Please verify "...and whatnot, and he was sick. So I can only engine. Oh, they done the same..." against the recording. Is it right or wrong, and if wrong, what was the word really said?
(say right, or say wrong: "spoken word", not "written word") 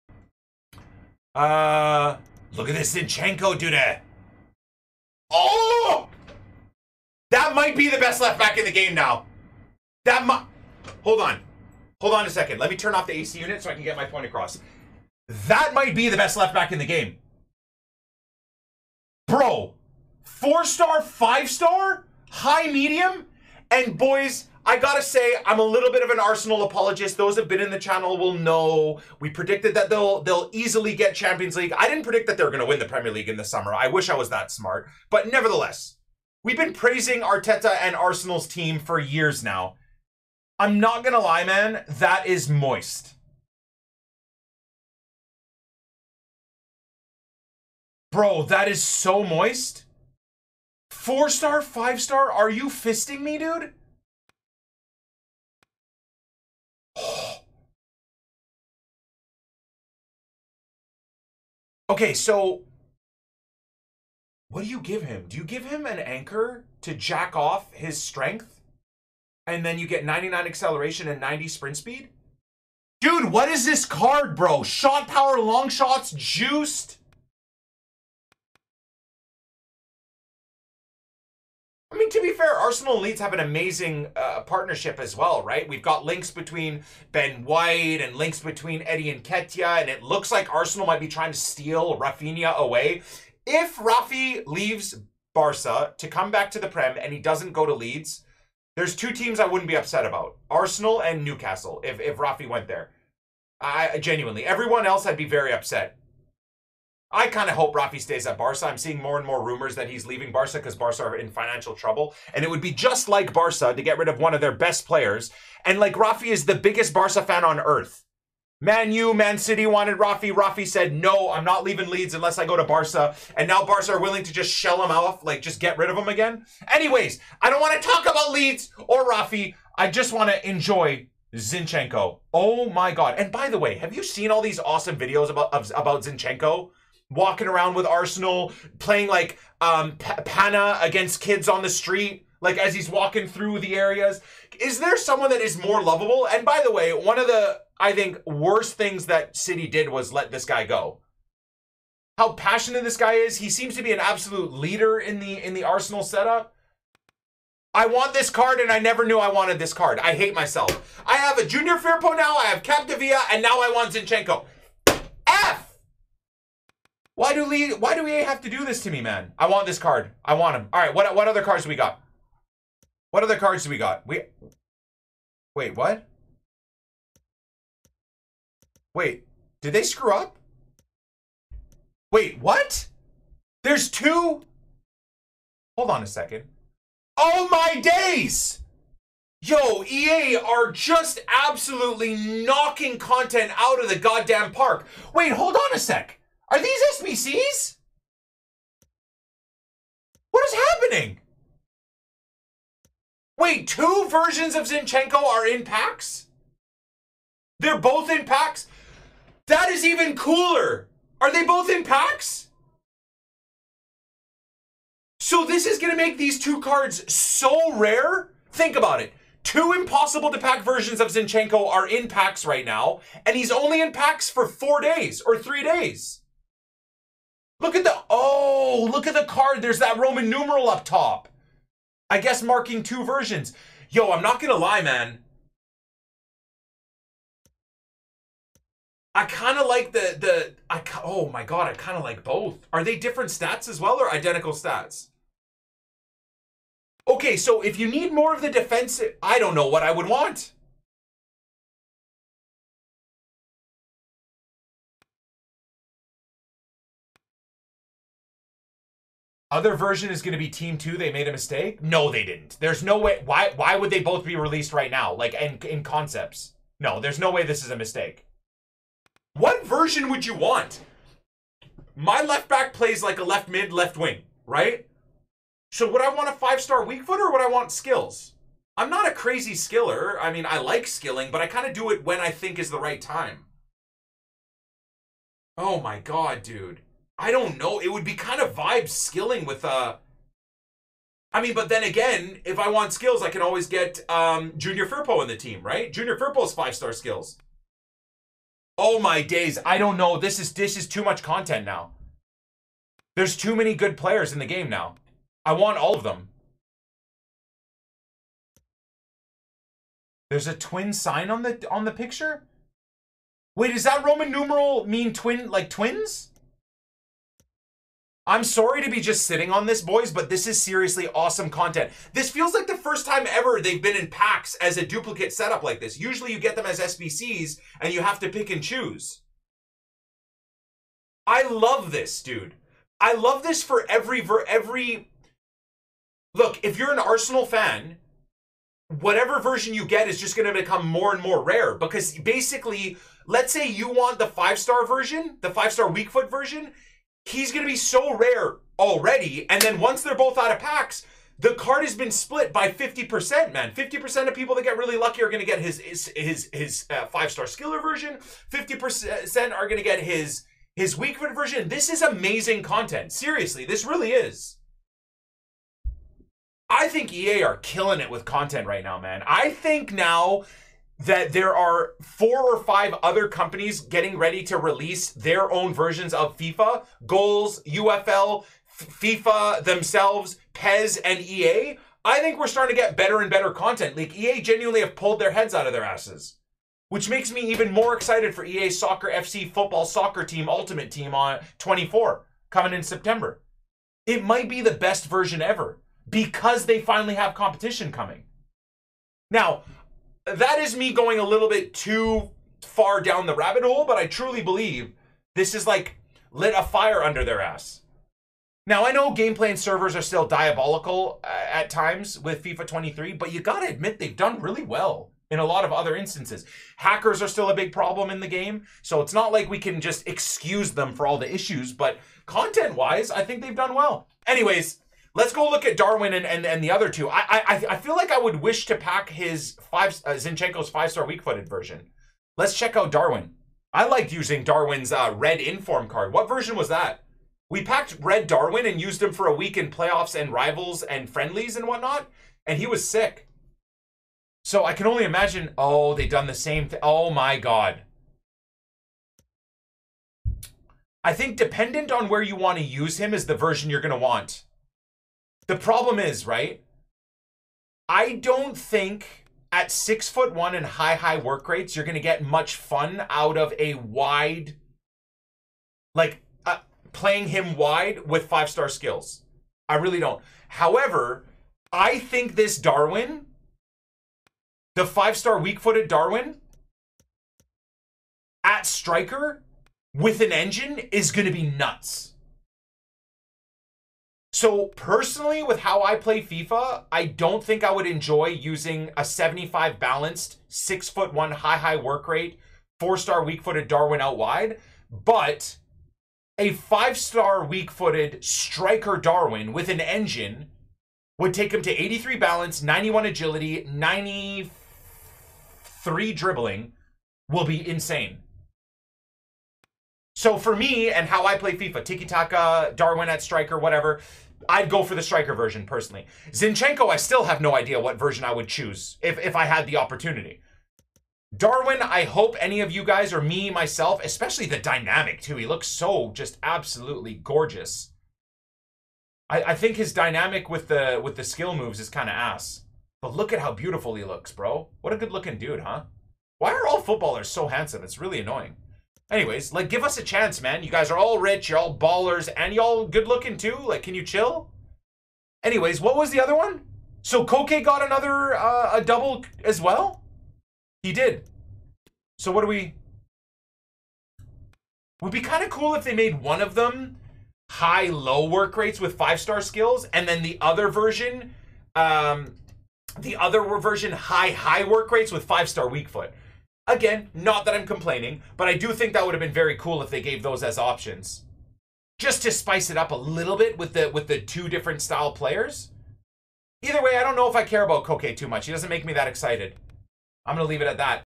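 wrong: "imagine", not "engine".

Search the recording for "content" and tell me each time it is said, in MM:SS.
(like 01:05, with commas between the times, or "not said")
03:12, 05:01, 05:21, 06:02, 06:08, 06:23, 07:02.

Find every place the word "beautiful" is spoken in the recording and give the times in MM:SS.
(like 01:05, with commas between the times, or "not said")
08:53.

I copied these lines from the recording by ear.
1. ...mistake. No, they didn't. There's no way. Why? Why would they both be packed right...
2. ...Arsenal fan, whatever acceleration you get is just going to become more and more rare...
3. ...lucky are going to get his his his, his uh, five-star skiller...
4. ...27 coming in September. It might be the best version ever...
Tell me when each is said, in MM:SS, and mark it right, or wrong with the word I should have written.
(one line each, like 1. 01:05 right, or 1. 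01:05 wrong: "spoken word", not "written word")
1. 04:21 wrong: "released", not "packed"
2. 05:36 wrong: "version", not "acceleration"
3. 05:54 right
4. 06:31 wrong: "24", not "27".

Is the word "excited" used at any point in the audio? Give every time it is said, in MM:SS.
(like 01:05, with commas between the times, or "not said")
06:27, 09:39.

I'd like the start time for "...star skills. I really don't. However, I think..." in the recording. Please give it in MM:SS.
07:48.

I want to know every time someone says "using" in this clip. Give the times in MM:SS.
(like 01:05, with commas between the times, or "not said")
07:14, 08:08.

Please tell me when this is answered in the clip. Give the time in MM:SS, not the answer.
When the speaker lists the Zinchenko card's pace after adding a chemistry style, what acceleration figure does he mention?
01:10.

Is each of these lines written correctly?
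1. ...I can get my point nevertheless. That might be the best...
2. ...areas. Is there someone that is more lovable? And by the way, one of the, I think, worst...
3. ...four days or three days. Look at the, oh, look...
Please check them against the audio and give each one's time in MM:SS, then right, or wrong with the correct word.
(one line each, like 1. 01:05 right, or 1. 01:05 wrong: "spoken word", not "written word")
1. 00:13 wrong: "across", not "nevertheless"
2. 02:23 right
3. 03:44 right.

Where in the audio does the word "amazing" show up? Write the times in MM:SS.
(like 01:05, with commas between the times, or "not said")
01:23, 06:02.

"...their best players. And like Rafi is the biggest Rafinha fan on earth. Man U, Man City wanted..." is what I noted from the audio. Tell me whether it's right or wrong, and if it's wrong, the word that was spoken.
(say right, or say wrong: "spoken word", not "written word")
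wrong: "Barca", not "Rafinha".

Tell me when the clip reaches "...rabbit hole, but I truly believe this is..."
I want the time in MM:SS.
06:43.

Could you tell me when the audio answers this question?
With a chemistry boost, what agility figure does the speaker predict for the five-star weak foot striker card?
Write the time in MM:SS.
08:22.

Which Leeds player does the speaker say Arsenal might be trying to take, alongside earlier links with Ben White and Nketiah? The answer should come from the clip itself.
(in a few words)
Rafinha.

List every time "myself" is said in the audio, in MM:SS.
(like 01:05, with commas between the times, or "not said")
02:40, 08:43.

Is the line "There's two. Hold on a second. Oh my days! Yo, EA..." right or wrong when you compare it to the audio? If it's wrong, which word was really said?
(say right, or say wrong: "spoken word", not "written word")
right.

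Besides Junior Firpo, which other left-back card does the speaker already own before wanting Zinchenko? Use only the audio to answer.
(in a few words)
Capdevila.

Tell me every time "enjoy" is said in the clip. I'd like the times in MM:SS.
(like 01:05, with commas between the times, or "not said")
02:10, 08:07.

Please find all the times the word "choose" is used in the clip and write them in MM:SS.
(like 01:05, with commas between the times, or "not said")
05:28, 08:38.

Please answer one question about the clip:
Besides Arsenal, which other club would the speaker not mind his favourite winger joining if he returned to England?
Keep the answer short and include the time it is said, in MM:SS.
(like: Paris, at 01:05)
Newcastle, at 01:41.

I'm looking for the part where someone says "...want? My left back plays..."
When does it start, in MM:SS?
04:30.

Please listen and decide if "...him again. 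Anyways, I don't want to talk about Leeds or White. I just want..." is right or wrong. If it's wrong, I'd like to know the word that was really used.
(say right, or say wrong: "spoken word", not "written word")
wrong: "Rafi", not "White".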